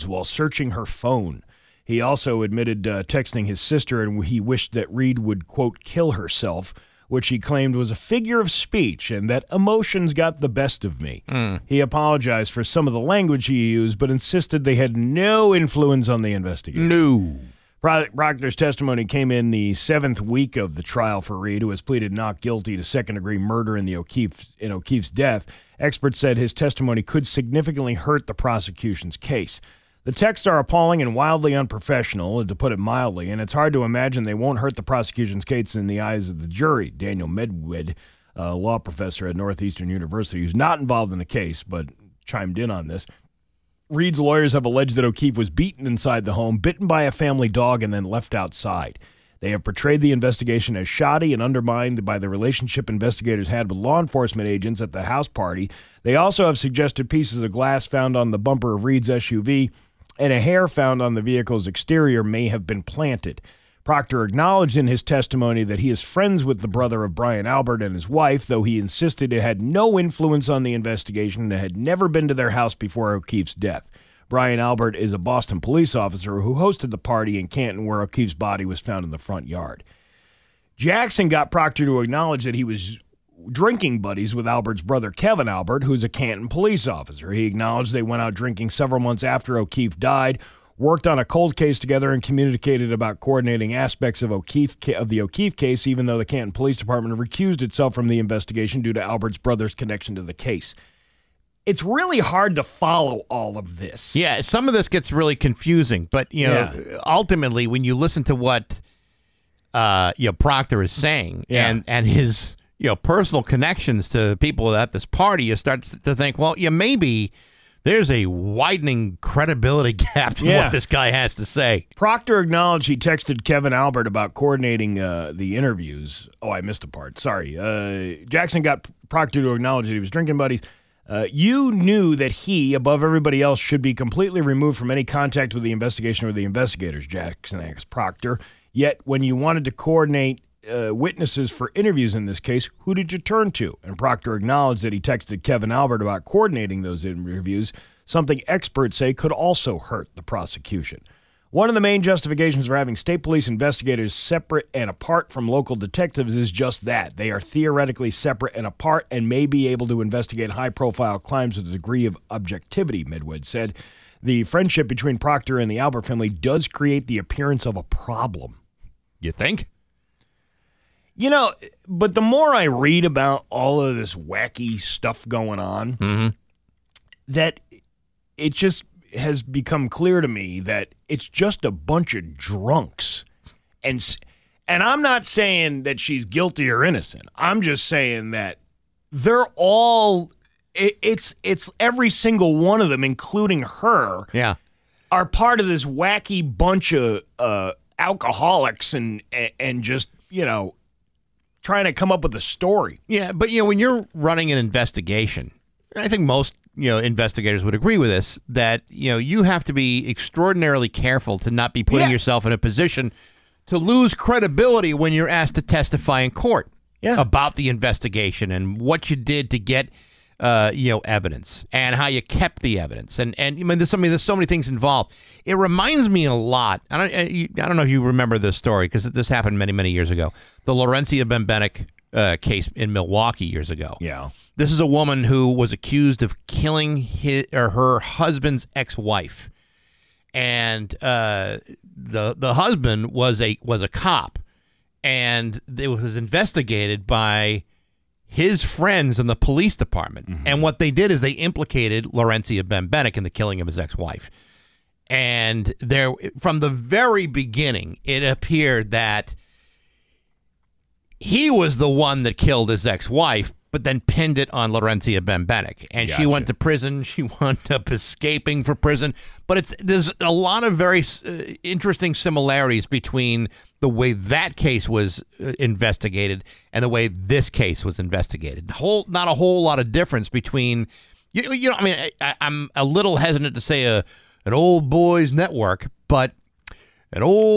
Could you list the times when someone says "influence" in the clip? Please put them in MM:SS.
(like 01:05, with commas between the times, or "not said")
00:15, 01:09.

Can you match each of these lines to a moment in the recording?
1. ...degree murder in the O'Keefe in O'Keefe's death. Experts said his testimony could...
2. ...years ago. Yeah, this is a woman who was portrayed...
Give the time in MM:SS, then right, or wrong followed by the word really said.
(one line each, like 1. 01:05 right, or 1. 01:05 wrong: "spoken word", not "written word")
1. 00:23 right
2. 03:53 wrong: "accused", not "portrayed".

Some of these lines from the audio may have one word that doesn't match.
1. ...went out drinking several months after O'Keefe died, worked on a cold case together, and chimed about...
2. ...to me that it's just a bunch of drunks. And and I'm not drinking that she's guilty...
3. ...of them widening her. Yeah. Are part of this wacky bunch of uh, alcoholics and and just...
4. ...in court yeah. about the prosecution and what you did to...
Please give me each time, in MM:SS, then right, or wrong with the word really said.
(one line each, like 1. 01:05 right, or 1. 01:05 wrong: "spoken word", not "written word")
1. 01:28 wrong: "communicated", not "chimed"
2. 03:00 wrong: "saying", not "drinking"
3. 03:12 wrong: "including", not "widening"
4. 03:36 wrong: "investigation", not "prosecution".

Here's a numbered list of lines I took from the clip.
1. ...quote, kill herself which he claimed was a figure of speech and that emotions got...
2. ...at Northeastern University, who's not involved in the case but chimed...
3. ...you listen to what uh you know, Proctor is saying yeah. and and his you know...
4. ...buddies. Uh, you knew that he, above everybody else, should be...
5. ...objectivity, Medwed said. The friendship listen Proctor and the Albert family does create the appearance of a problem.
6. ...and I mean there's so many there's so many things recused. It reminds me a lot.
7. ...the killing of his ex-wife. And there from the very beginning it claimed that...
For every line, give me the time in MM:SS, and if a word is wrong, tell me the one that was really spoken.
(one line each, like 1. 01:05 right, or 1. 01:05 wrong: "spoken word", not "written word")
1. 00:05 right
2. 00:39 right
3. 01:47 right
4. 02:10 right
5. 02:42 wrong: "between", not "listen"
6. 03:43 wrong: "involved", not "recused"
7. 04:13 wrong: "appeared", not "claimed".